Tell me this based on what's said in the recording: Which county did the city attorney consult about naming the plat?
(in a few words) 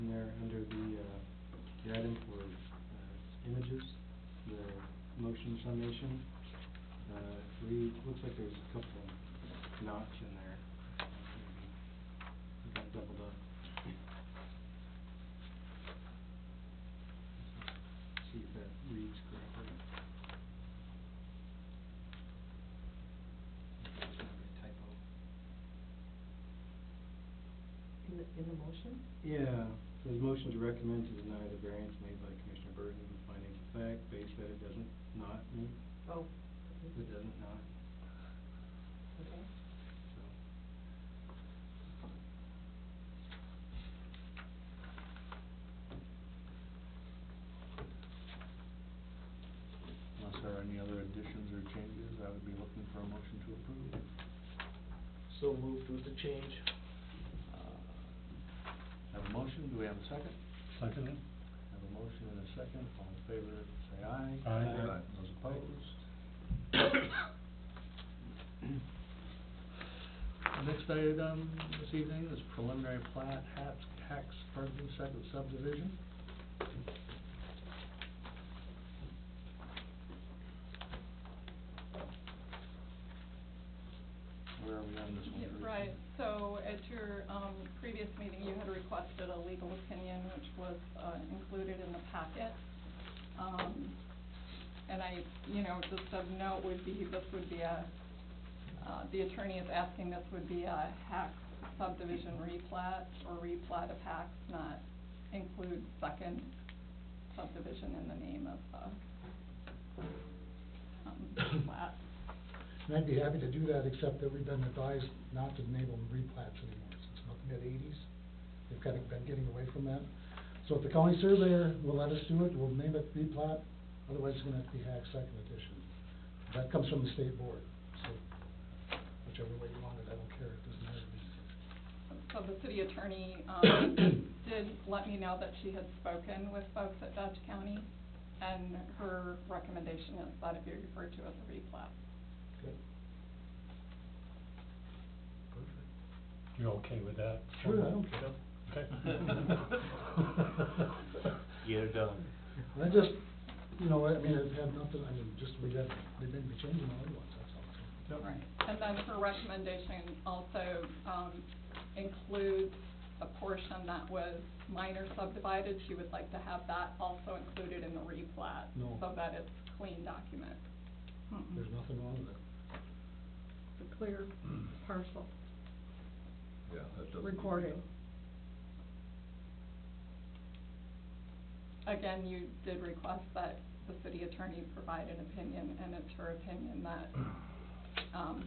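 Dodge County.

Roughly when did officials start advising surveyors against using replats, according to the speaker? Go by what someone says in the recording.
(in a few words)
mid-eighties.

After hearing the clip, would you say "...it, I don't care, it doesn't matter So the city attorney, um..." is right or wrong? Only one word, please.
right.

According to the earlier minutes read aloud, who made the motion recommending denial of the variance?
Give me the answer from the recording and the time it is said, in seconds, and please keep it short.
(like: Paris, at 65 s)
Commissioner Burton, at 32 s.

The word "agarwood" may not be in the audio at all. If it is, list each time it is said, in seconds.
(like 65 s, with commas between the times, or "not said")
not said.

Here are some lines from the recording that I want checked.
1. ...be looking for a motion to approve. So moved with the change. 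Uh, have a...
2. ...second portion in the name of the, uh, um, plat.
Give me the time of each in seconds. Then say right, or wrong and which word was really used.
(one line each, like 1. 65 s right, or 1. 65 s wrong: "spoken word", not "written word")
1. 52 s right
2. 106 s wrong: "subdivision", not "portion".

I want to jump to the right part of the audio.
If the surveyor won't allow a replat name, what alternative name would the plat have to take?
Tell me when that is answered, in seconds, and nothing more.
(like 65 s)
124 s.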